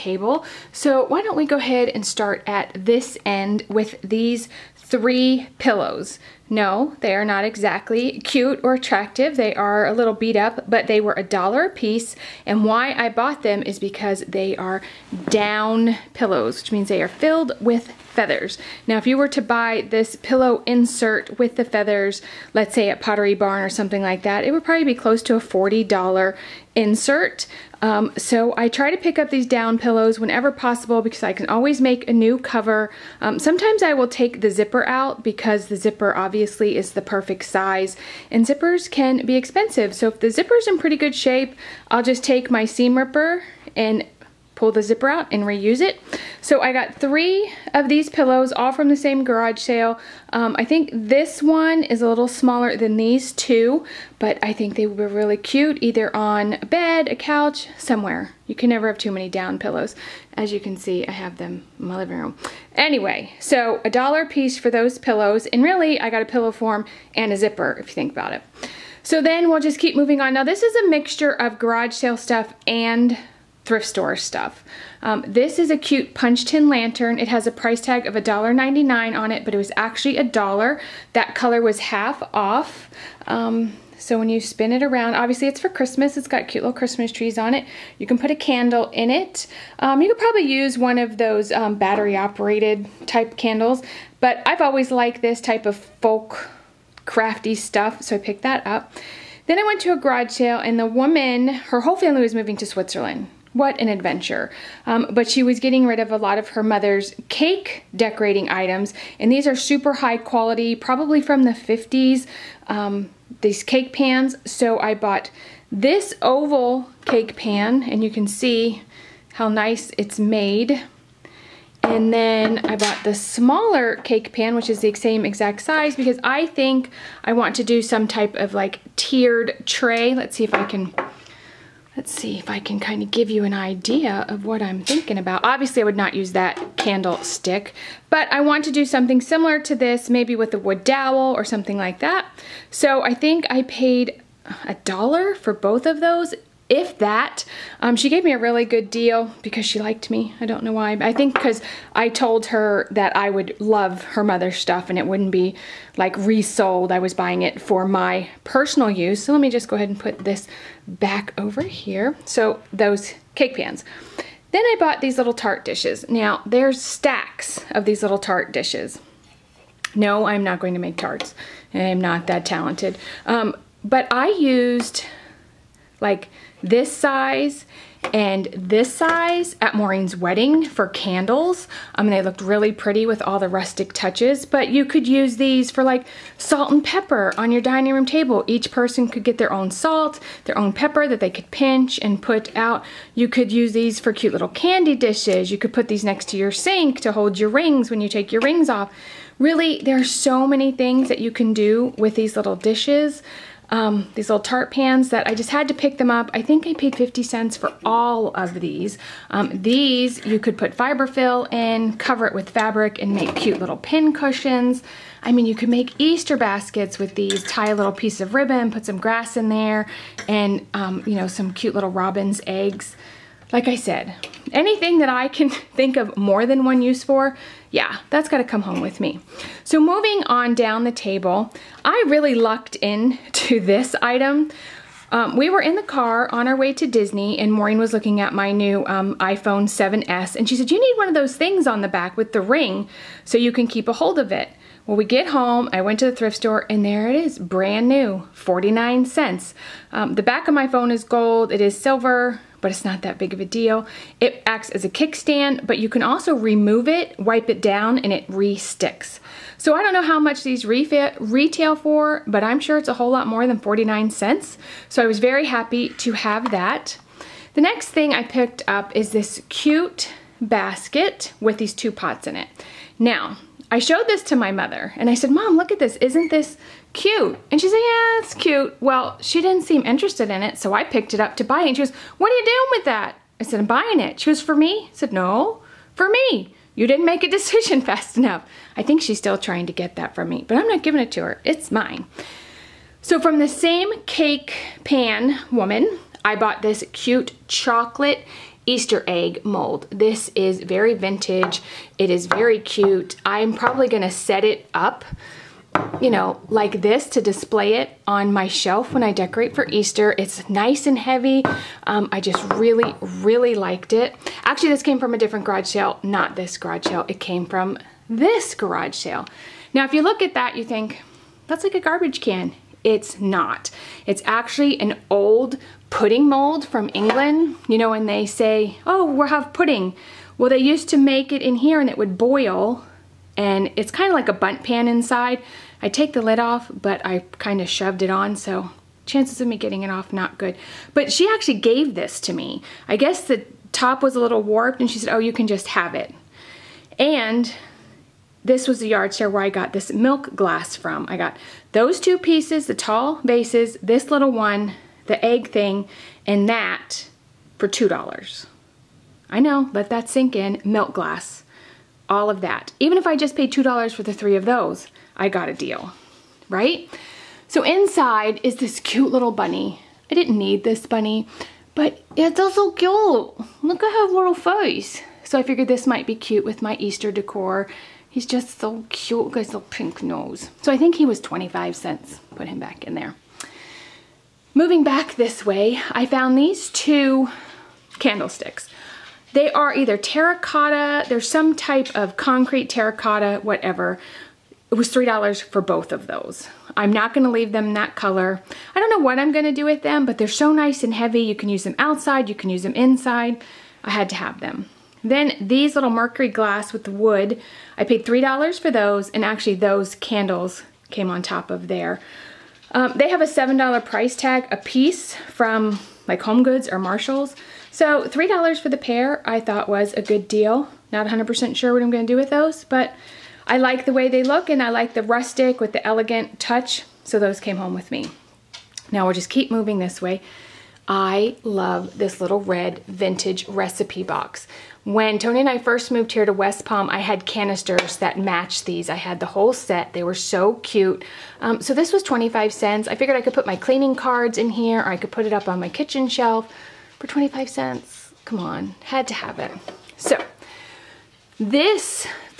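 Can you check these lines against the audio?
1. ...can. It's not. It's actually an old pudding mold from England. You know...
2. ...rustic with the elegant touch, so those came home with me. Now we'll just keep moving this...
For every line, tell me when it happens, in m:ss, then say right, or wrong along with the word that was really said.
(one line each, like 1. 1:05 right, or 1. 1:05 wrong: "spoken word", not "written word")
1. 5:22 right
2. 7:05 right.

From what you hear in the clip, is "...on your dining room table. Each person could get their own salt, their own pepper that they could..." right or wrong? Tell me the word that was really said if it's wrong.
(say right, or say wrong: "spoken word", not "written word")
right.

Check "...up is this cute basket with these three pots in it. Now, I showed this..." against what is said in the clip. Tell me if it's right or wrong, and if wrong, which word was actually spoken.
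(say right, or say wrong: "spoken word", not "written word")
wrong: "two", not "three".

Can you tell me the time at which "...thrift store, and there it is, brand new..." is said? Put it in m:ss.
4:06.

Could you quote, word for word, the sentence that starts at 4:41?
And she goes, what are you doing with that?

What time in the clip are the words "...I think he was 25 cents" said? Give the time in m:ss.
6:20.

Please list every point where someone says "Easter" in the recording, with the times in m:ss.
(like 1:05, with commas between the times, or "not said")
3:35, 4:58, 5:09, 6:16.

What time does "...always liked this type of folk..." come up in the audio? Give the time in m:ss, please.
1:34.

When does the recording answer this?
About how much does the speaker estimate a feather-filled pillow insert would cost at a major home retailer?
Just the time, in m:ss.
0:25.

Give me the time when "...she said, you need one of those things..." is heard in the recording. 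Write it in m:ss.
4:00.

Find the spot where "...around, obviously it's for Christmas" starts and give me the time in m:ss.
1:24.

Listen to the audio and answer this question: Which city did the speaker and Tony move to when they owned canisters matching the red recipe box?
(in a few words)
West Palm.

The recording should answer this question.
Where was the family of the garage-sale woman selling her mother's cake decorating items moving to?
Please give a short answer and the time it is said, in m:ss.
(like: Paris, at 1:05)
Switzerland, at 1:42.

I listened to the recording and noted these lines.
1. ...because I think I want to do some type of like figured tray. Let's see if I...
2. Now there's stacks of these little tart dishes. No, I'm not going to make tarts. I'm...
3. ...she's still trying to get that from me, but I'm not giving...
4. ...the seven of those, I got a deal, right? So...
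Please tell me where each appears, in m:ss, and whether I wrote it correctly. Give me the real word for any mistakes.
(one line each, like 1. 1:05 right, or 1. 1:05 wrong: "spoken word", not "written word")
1. 2:05 wrong: "tiered", not "figured"
2. 2:46 right
3. 4:49 right
4. 6:04 wrong: "three", not "seven".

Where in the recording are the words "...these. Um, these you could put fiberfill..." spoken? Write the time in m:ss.
3:28.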